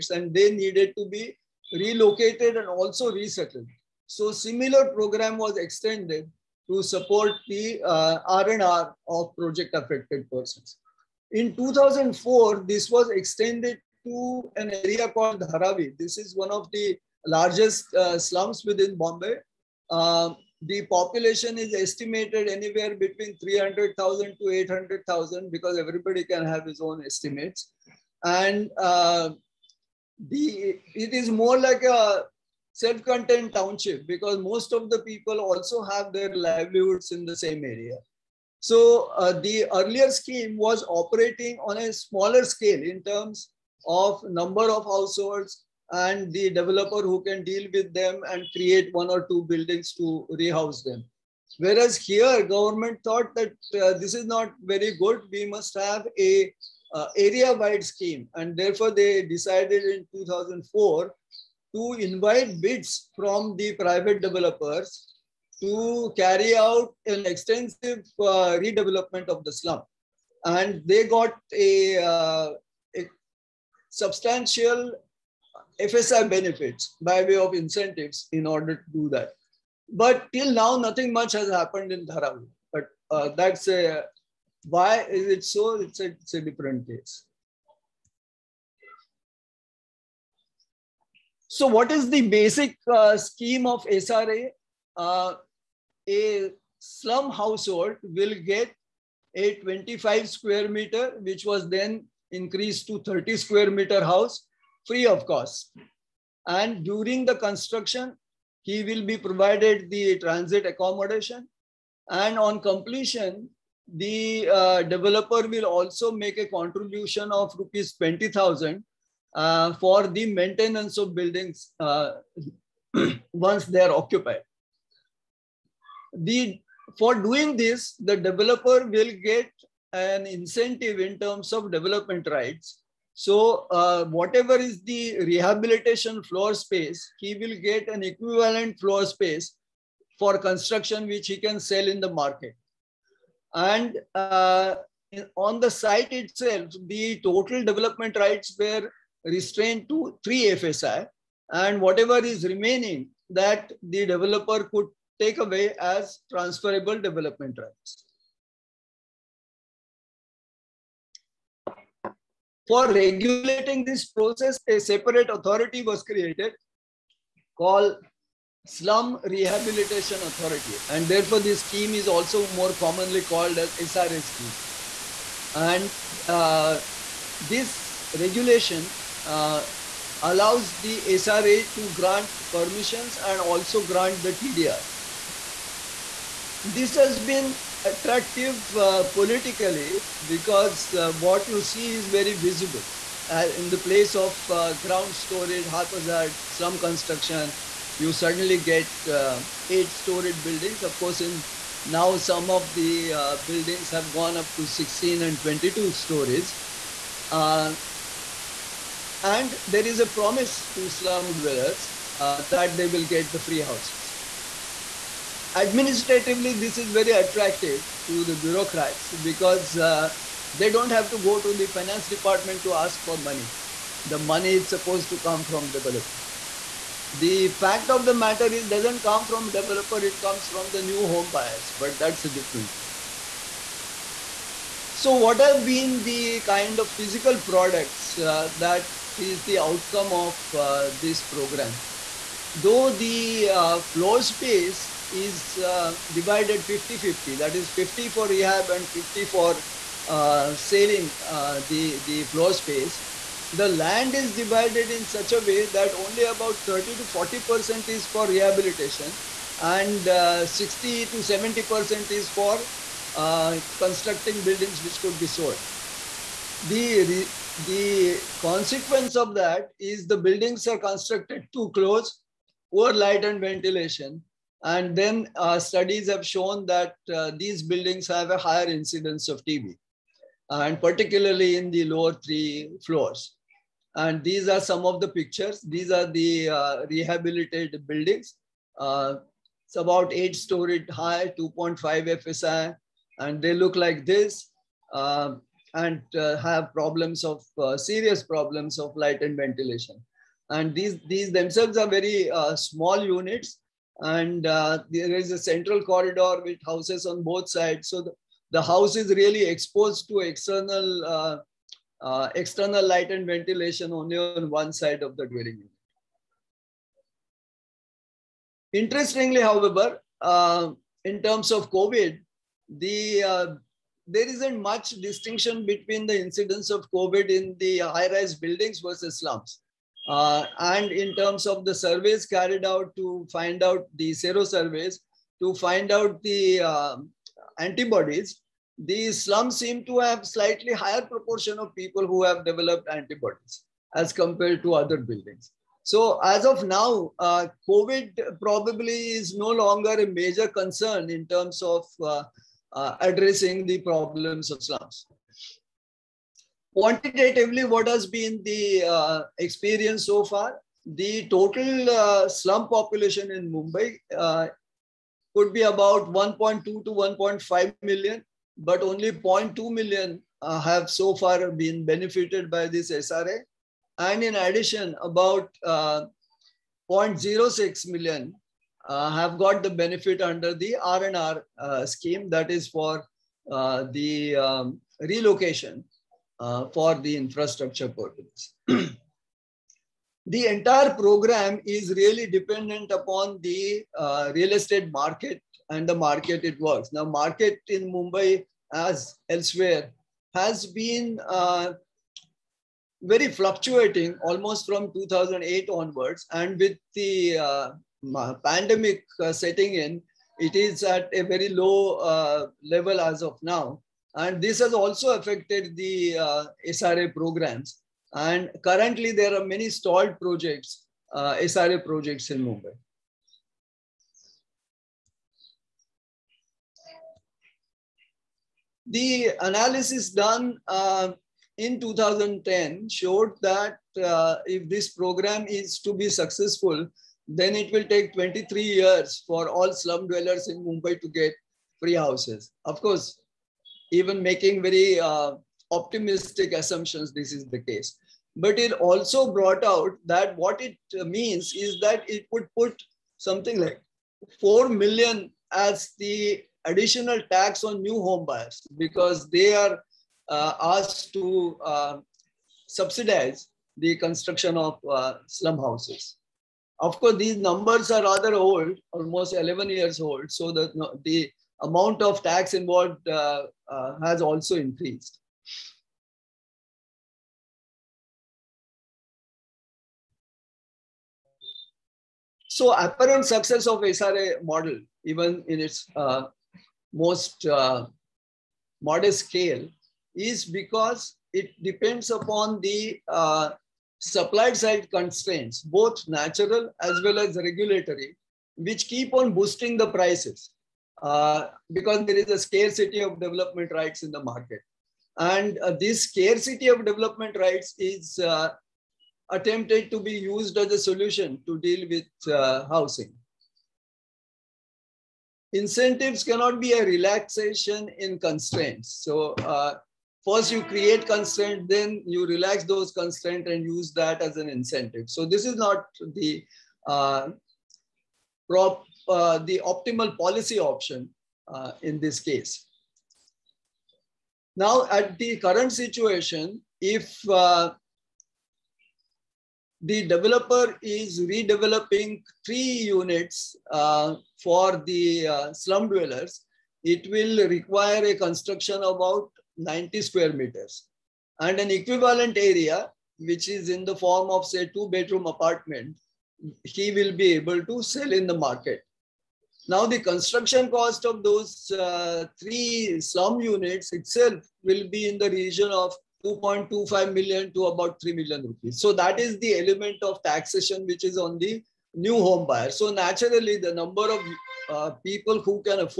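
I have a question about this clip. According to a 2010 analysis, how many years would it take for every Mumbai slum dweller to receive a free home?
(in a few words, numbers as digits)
23 years.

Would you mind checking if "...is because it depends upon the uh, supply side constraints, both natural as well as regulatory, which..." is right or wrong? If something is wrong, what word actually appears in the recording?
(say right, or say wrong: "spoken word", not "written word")
right.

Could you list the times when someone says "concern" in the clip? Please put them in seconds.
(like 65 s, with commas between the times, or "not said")
350 s.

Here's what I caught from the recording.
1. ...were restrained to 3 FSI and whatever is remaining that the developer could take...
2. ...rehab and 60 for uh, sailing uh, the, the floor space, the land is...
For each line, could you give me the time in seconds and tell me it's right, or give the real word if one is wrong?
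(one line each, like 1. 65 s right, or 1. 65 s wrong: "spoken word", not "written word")
1. 148 s right
2. 248 s wrong: "50", not "60".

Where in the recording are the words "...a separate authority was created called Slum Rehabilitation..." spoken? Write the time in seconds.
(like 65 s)
164 s.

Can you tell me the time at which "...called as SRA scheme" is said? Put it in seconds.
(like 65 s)
173 s.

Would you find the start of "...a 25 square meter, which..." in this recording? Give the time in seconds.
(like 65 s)
99 s.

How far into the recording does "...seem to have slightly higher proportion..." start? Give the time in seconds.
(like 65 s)
339 s.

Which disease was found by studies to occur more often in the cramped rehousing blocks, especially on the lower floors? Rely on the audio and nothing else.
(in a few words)
TB.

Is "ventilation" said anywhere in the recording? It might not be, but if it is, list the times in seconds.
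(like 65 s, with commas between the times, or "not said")
273 s, 299 s, 313 s.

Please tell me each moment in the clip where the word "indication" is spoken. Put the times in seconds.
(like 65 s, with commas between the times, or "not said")
not said.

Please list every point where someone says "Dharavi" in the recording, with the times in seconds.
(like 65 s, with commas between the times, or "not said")
15 s, 82 s.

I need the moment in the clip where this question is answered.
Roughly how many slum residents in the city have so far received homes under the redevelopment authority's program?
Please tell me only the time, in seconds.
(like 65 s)
368 s.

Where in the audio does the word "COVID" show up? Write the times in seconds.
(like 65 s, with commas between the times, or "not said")
321 s, 326 s, 347 s.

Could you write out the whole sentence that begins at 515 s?
Incentives cannot be a relaxation in constraints.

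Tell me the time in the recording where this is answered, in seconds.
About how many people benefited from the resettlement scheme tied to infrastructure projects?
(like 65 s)
376 s.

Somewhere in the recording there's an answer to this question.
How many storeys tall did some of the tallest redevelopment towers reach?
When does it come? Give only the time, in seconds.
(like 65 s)
205 s.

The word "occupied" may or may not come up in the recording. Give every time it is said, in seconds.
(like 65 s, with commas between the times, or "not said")
123 s.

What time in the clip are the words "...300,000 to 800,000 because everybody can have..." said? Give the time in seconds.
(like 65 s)
23 s.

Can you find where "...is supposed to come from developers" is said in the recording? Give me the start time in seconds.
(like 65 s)
224 s.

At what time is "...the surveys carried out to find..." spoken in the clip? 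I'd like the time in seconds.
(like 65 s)
331 s.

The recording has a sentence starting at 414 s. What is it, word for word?
And this has also affected the uh, SRA programs.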